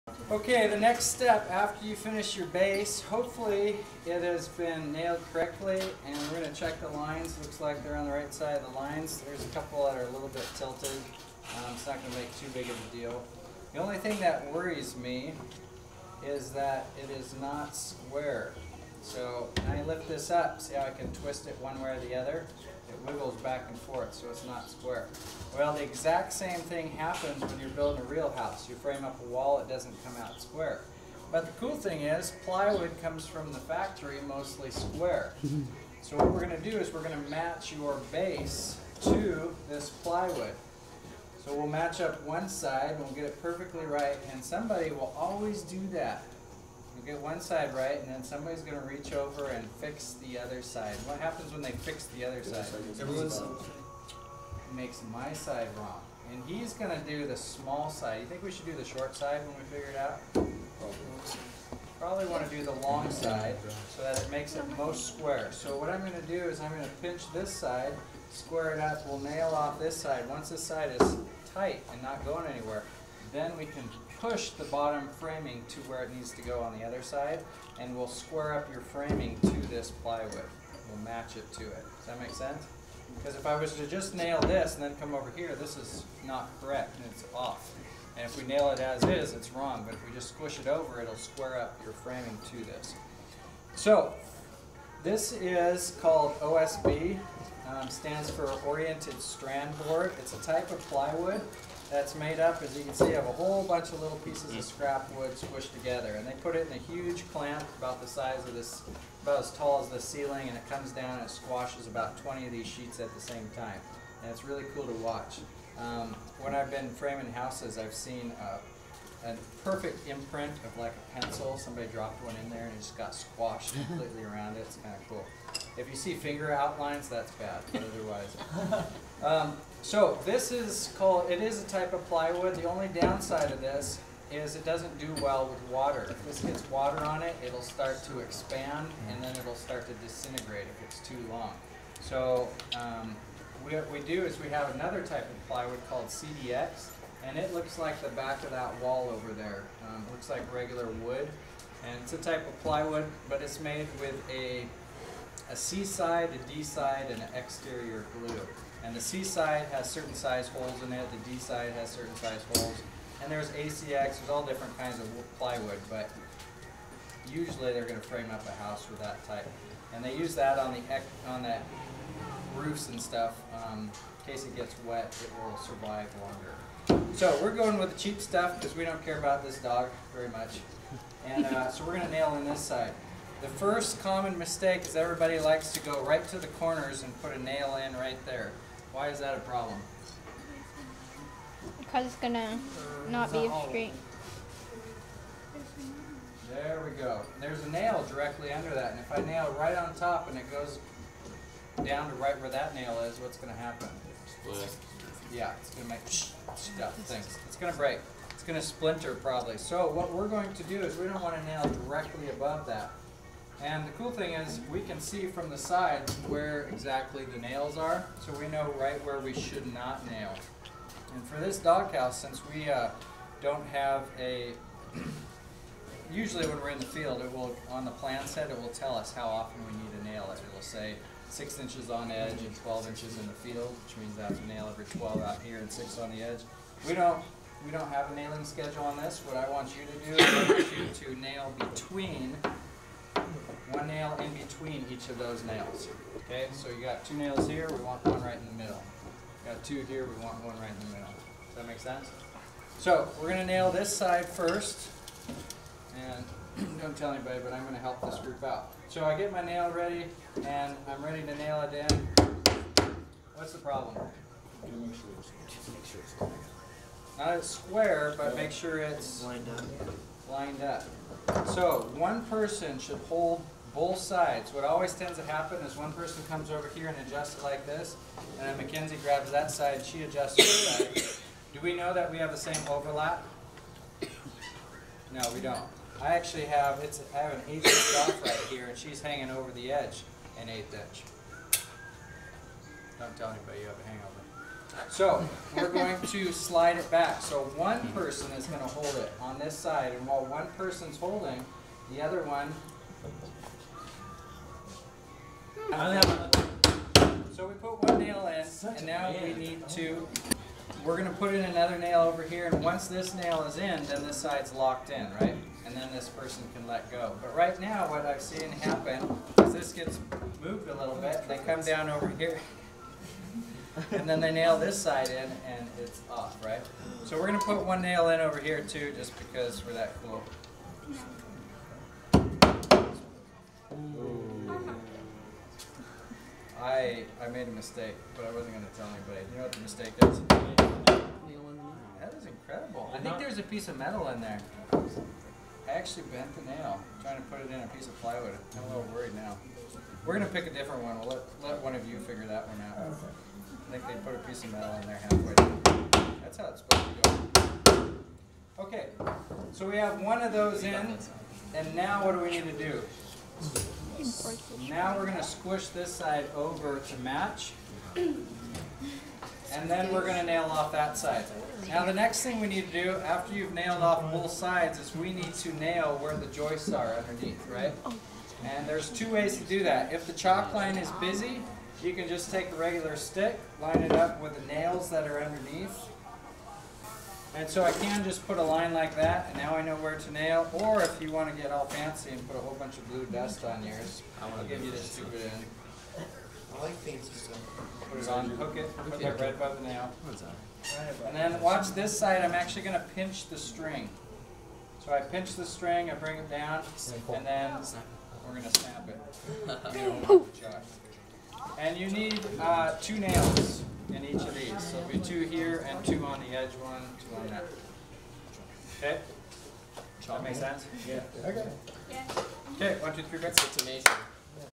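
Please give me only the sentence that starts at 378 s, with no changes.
And there's two ways to do that.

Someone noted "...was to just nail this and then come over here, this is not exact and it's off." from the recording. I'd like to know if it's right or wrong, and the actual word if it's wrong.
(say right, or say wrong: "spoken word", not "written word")
wrong: "correct", not "exact".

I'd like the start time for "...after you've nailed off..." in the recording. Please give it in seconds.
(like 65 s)
373 s.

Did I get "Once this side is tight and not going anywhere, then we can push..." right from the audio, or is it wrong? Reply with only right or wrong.
right.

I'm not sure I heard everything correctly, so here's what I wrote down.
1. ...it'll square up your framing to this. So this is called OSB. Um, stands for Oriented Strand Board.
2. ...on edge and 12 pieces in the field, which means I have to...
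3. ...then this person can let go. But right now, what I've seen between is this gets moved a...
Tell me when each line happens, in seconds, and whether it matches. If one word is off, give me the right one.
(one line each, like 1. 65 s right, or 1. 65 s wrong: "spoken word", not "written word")
1. 91 s right
2. 231 s wrong: "inches", not "pieces"
3. 315 s wrong: "happen", not "between".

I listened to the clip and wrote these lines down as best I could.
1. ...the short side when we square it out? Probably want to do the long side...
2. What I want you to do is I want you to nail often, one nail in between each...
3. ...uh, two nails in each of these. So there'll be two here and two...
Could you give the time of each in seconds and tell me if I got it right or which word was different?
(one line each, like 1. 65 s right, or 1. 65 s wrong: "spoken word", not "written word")
1. 58 s wrong: "figure", not "square"
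2. 239 s wrong: "between", not "often"
3. 412 s right.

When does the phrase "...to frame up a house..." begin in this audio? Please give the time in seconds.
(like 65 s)
167 s.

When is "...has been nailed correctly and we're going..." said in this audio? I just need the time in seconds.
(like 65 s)
4 s.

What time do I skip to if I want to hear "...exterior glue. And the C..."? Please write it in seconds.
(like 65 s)
157 s.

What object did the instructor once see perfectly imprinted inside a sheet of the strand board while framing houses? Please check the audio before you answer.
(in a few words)
A pencil.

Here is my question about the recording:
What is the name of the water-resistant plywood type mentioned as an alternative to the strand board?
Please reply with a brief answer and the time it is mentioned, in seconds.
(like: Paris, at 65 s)
CDX, at 146 s.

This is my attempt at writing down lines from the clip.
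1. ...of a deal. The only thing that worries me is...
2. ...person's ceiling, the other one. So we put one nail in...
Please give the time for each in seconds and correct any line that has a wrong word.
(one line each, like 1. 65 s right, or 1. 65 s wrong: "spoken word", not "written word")
1. 12 s right
2. 300 s wrong: "holding", not "ceiling".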